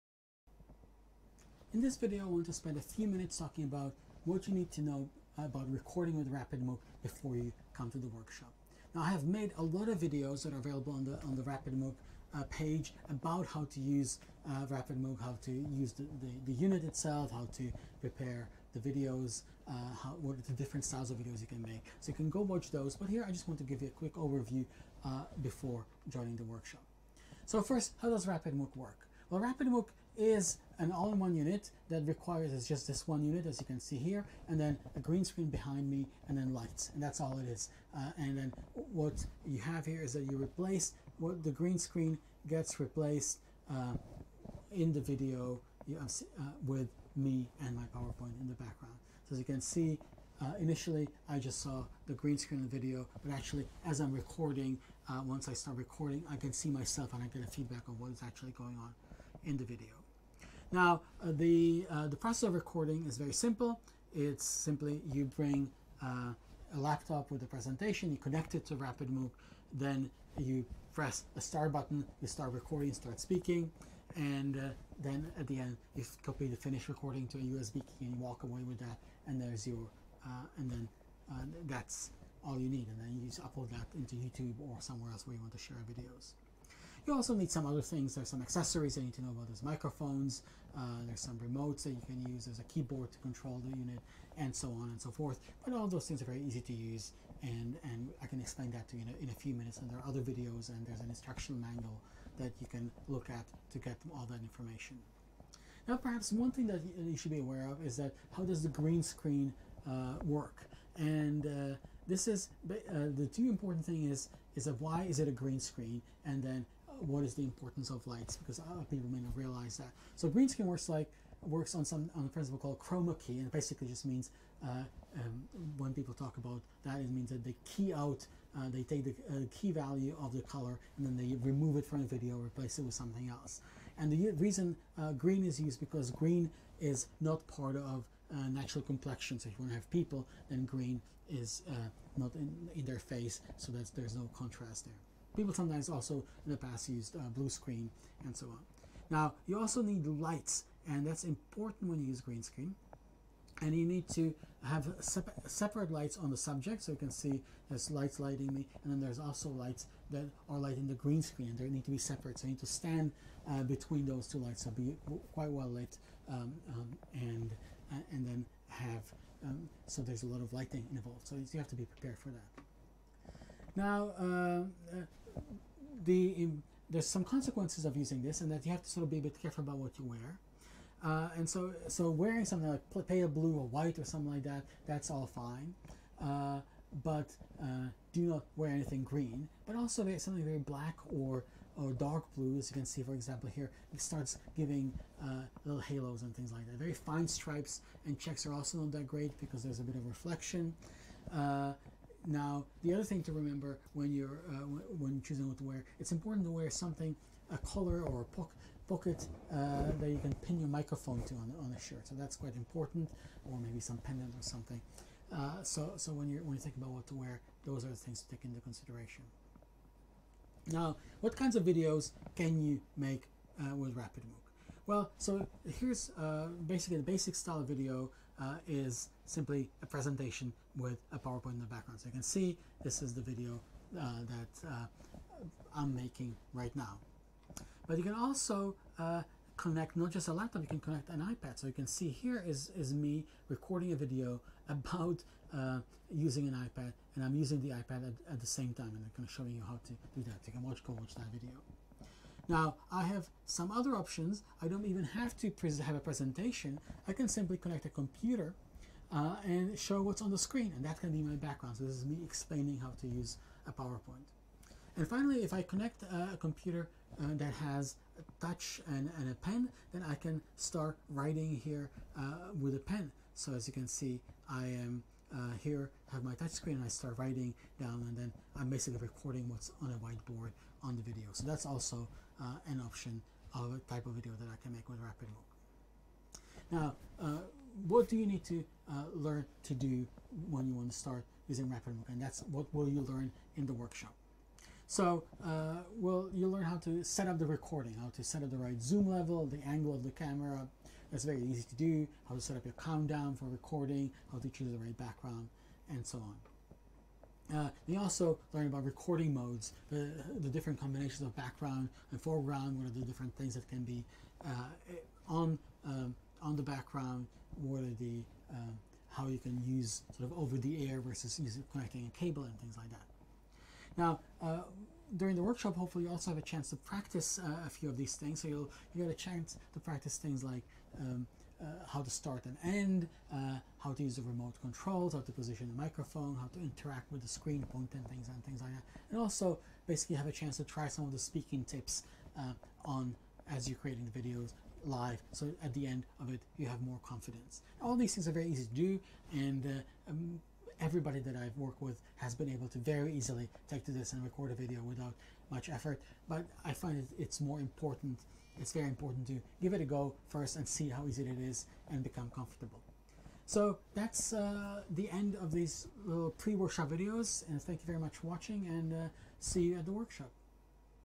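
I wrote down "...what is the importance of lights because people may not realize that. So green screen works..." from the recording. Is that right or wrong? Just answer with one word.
right.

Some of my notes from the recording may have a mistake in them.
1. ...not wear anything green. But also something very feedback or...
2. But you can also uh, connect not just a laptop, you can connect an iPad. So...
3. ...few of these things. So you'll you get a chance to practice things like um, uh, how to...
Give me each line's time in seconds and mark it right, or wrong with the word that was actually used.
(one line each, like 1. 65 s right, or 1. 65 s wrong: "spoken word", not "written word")
1. 188 s wrong: "black", not "feedback"
2. 237 s right
3. 327 s right.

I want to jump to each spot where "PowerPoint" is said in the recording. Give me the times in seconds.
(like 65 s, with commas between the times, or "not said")
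47 s, 231 s, 263 s.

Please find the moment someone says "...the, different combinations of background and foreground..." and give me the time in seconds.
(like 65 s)
310 s.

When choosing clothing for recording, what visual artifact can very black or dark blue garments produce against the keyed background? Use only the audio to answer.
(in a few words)
halos.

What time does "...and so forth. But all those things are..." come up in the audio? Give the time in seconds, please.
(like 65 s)
94 s.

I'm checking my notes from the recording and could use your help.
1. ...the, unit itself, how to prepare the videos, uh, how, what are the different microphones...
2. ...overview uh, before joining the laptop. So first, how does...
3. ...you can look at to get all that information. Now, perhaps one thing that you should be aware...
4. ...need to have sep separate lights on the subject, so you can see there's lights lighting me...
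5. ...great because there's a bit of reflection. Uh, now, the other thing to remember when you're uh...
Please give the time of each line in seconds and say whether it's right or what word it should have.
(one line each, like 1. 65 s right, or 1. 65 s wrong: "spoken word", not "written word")
1. 16 s wrong: "styles", not "microphones"
2. 24 s wrong: "workshop", not "laptop"
3. 102 s right
4. 153 s right
5. 199 s right.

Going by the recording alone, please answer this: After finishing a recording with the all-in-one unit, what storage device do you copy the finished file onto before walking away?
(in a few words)
USB key.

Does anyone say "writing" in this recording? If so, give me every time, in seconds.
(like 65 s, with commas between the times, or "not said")
271 s, 277 s.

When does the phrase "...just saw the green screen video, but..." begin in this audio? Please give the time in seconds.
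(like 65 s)
51 s.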